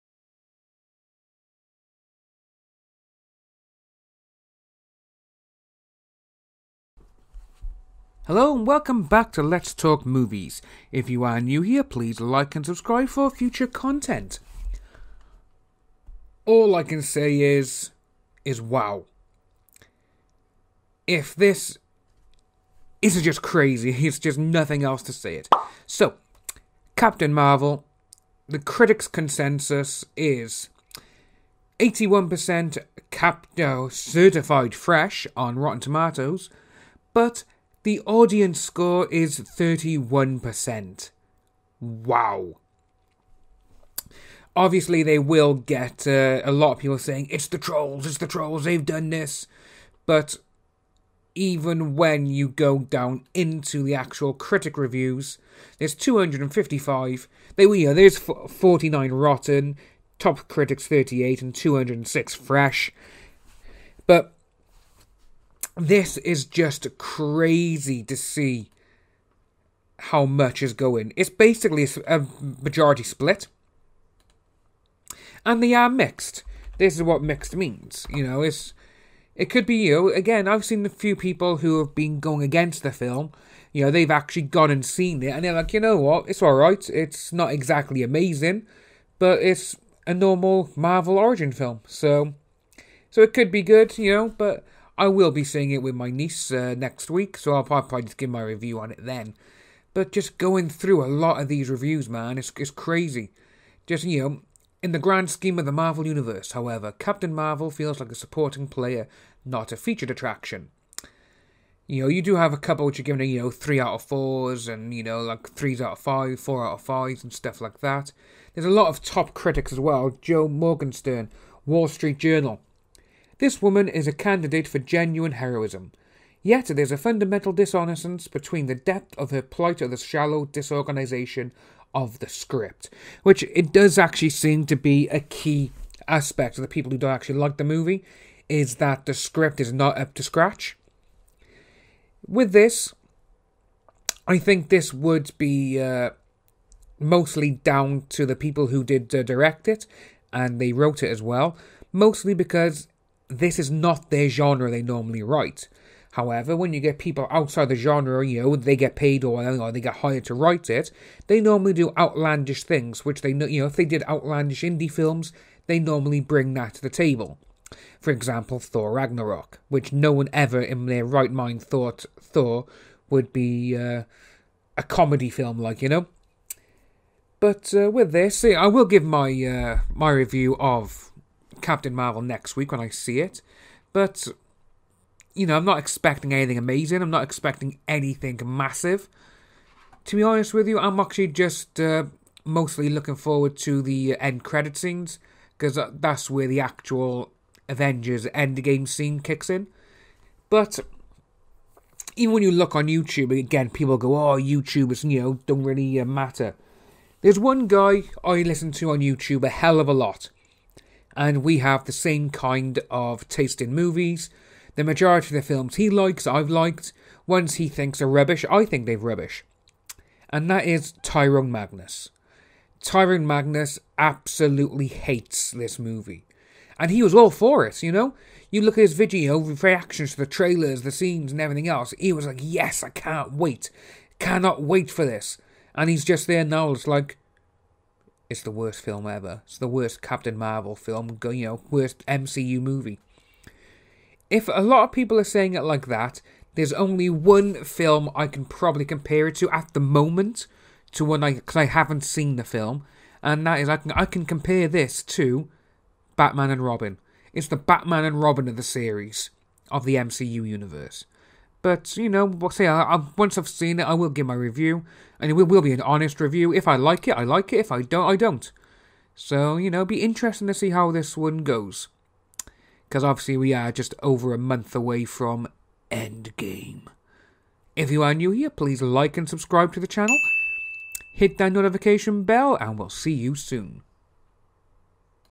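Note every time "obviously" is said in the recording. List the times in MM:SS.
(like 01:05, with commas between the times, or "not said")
00:44, 04:33.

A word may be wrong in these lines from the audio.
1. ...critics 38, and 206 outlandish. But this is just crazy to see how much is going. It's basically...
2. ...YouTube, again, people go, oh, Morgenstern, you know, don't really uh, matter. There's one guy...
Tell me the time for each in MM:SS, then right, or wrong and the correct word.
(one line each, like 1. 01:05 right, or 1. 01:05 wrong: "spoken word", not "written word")
1. 01:00 wrong: "fresh", not "outlandish"
2. 03:22 wrong: "YouTubers", not "Morgenstern".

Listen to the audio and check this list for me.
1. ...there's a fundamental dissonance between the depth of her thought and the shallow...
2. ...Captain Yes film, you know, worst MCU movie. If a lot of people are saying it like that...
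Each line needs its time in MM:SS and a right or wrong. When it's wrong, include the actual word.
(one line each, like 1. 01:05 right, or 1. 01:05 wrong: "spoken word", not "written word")
1. 02:06 wrong: "plight", not "thought"
2. 04:00 wrong: "Marvel", not "Yes".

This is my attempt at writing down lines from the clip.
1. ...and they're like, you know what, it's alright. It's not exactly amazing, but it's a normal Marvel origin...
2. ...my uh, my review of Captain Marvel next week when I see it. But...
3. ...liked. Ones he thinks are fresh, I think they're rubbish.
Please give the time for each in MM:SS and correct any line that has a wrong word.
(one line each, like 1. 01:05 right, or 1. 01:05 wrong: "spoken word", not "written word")
1. 01:25 right
2. 02:59 right
3. 03:36 wrong: "rubbish", not "fresh".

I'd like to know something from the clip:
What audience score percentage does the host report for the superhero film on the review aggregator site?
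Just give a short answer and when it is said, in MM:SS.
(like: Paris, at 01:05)
31%, at 00:39.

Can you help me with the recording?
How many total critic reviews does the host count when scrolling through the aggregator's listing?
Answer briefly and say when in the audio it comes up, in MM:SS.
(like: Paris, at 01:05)
255, at 00:55.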